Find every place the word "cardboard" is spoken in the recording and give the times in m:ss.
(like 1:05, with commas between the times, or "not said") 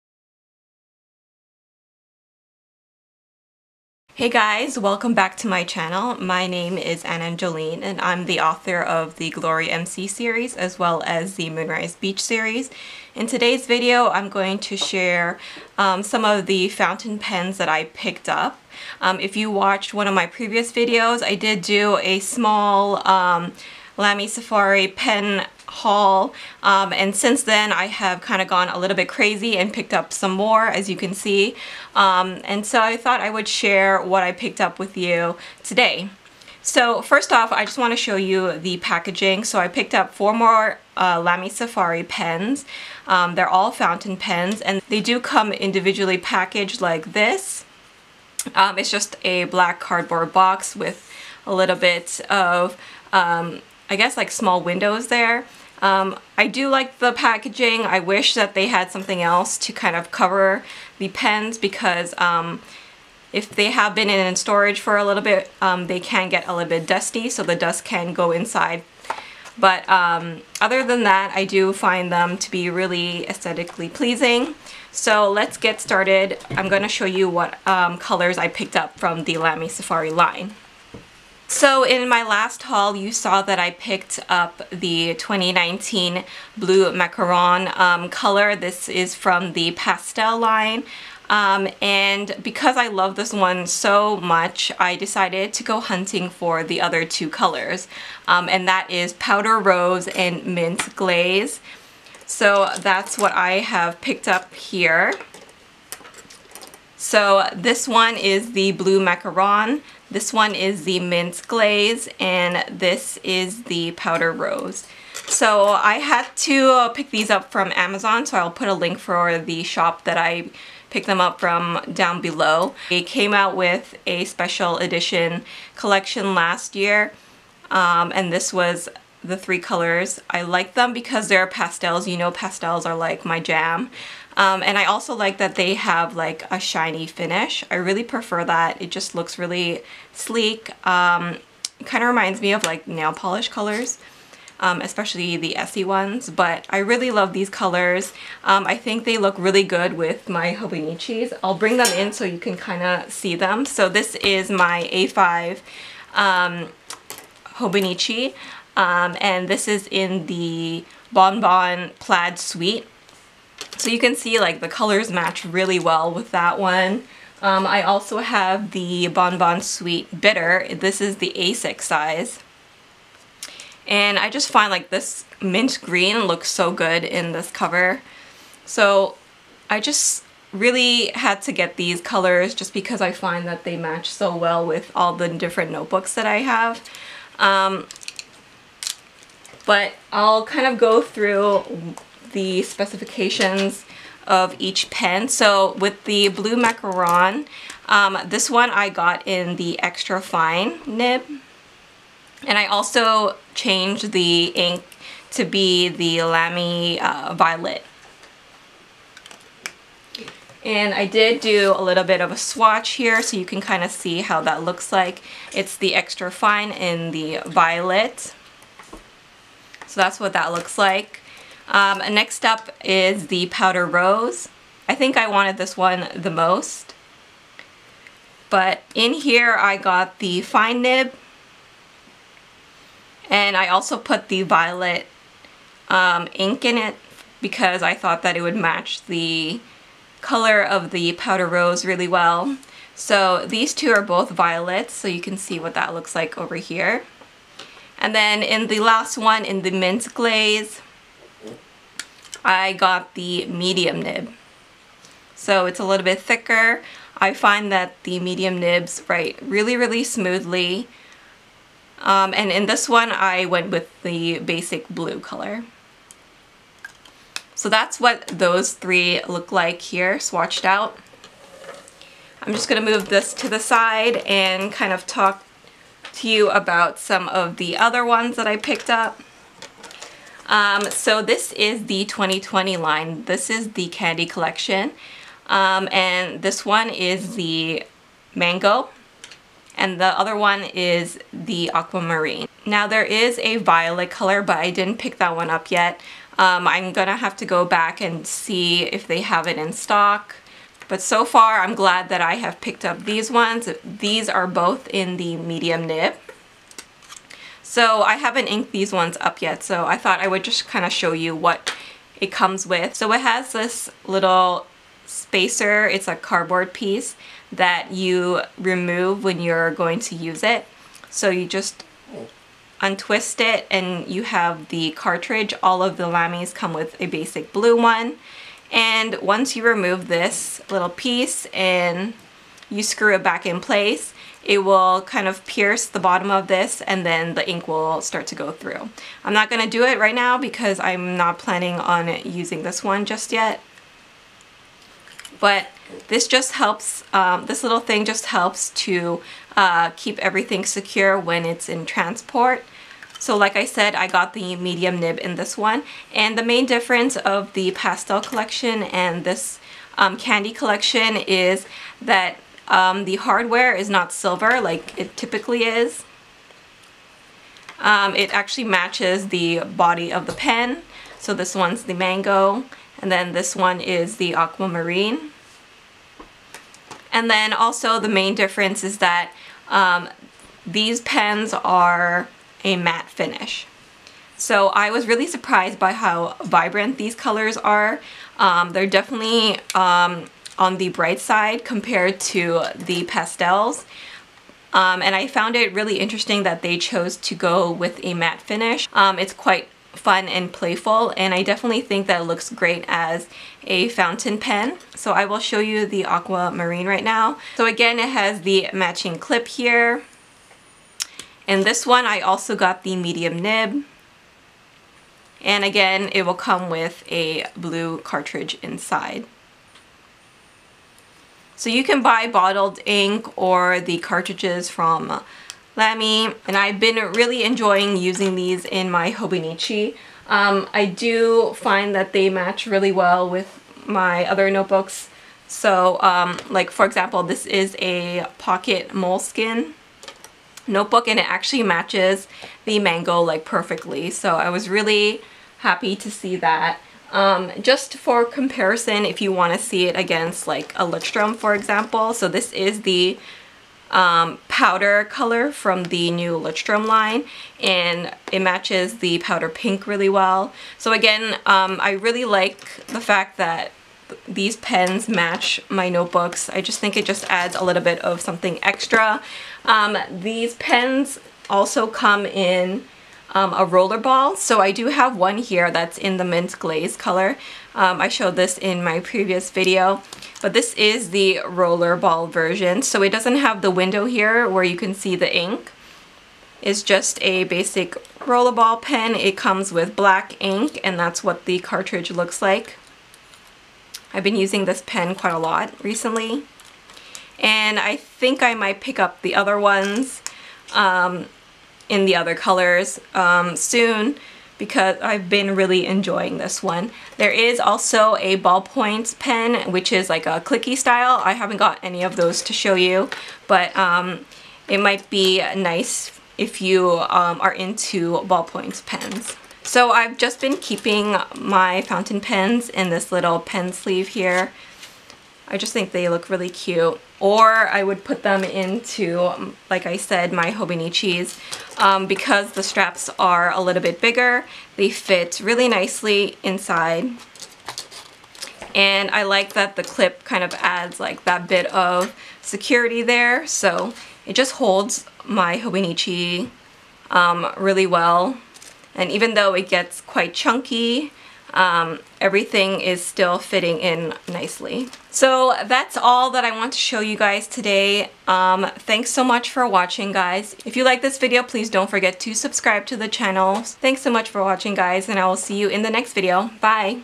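0:49, 5:16.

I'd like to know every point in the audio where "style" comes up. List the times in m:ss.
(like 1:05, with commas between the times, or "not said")
8:30.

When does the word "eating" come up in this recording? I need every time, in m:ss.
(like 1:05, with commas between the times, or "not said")
not said.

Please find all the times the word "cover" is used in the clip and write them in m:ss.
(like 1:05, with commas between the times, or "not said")
1:00, 2:57.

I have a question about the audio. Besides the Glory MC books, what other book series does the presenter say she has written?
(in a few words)
Moonrise Beach.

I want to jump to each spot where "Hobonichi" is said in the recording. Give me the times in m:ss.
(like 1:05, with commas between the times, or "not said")
2:30, 2:37, 7:09, 8:50, 9:05.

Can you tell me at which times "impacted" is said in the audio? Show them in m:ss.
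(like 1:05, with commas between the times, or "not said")
not said.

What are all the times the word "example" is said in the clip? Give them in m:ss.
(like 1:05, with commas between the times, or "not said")
7:16, 7:31.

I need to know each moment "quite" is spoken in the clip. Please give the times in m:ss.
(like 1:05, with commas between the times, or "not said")
6:39, 8:15, 9:09.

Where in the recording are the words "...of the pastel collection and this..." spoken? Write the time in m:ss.
5:57.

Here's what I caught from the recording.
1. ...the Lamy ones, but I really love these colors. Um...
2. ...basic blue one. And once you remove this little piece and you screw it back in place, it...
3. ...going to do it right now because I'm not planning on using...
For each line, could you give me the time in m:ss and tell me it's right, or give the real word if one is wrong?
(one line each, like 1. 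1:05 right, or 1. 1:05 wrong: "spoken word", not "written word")
1. 2:25 wrong: "Essie", not "Lamy"
2. 5:27 right
3. 5:39 right.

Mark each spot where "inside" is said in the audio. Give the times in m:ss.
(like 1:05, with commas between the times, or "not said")
1:08, 6:58, 8:56.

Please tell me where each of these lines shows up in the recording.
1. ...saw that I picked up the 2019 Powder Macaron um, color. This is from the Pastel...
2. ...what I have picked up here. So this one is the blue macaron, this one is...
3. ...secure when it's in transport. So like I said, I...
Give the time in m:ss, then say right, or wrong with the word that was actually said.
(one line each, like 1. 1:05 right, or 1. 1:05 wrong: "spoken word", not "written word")
1. 1:23 wrong: "Blue", not "Powder"
2. 1:43 right
3. 5:50 right.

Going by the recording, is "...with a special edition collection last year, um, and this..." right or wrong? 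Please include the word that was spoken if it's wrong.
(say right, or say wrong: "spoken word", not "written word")
right.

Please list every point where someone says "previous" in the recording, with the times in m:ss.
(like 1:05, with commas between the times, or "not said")
0:20, 7:58.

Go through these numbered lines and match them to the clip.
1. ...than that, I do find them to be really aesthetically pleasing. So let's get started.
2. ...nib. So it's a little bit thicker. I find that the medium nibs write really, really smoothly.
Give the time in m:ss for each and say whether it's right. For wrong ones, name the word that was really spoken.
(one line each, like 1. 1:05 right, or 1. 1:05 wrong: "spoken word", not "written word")
1. 1:10 right
2. 4:14 right.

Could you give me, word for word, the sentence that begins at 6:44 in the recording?
So I will show you the aquamarine right now.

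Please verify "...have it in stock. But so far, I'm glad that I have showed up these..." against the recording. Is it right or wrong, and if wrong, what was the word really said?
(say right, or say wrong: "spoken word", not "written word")
wrong: "picked", not "showed".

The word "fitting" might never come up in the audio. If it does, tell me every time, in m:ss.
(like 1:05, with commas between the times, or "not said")
9:13.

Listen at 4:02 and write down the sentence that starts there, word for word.
So these two are both violets, so you can see what that looks like over here.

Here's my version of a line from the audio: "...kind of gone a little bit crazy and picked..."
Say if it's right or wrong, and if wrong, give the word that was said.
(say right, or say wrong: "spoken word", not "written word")
right.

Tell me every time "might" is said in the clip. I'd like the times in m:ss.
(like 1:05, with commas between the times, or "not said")
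8:18, 8:34.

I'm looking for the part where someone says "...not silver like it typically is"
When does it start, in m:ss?
6:03.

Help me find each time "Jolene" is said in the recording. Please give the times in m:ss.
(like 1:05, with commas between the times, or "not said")
0:07.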